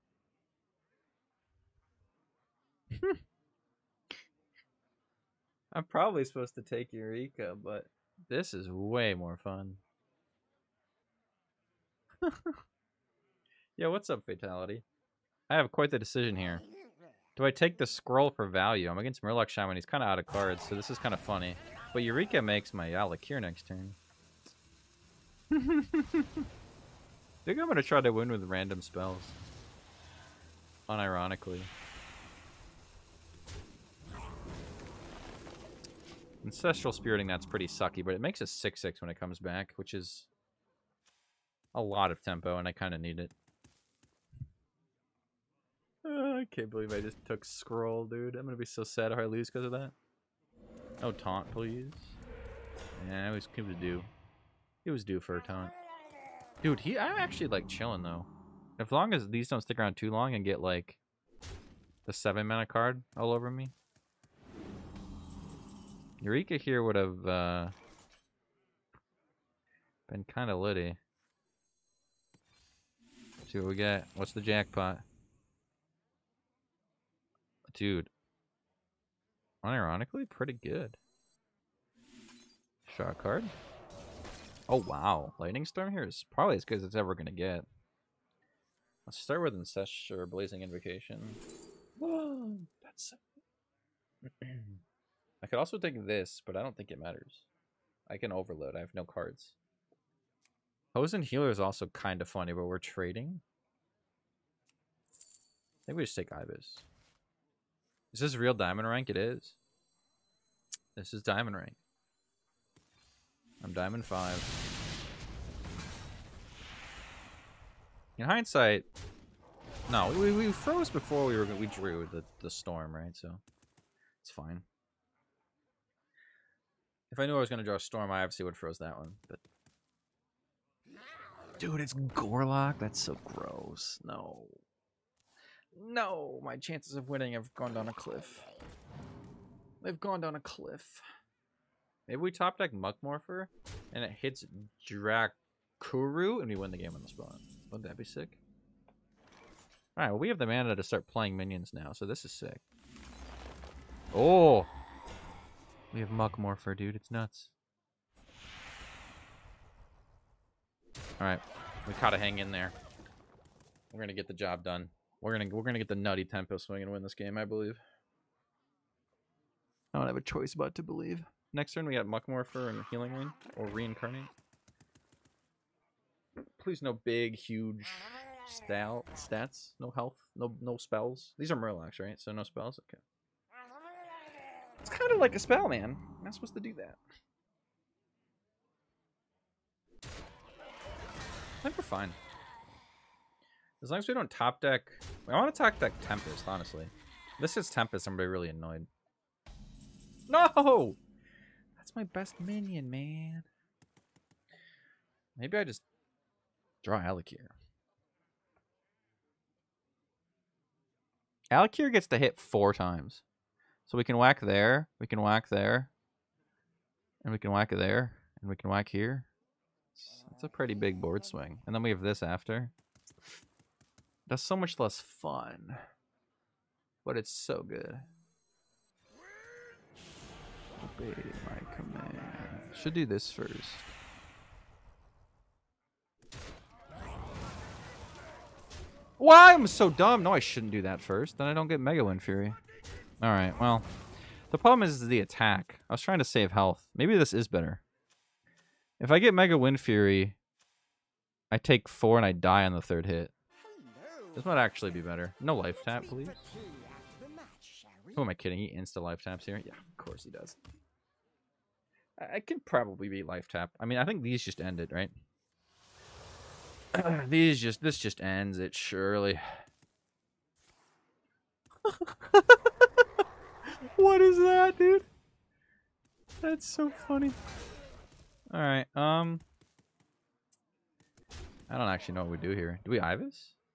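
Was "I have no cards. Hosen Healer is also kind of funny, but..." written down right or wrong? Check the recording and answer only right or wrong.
right.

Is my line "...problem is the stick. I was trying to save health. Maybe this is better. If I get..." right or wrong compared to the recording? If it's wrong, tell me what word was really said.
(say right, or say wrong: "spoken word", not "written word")
wrong: "attack", not "stick".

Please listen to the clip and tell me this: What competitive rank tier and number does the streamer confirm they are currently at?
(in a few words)
Diamond 5.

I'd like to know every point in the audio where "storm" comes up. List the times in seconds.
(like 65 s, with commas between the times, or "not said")
85 s, 122 s, 127 s.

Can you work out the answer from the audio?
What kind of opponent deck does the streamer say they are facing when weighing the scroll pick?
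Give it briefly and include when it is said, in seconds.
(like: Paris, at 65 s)
Murloc Shaman, at 19 s.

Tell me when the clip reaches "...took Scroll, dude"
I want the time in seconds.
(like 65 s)
47 s.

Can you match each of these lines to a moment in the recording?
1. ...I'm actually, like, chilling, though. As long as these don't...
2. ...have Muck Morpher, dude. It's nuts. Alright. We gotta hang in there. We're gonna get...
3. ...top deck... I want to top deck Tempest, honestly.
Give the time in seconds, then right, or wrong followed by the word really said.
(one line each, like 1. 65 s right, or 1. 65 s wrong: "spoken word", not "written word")
1. 56 s right
2. 156 s right
3. 194 s right.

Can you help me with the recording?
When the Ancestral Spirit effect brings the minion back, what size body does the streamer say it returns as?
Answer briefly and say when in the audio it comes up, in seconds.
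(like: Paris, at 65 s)
6-6, at 38 s.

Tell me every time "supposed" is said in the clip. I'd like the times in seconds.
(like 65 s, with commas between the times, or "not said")
6 s, 186 s.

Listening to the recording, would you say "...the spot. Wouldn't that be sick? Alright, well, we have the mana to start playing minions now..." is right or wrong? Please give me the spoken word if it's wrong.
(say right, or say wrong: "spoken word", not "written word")
right.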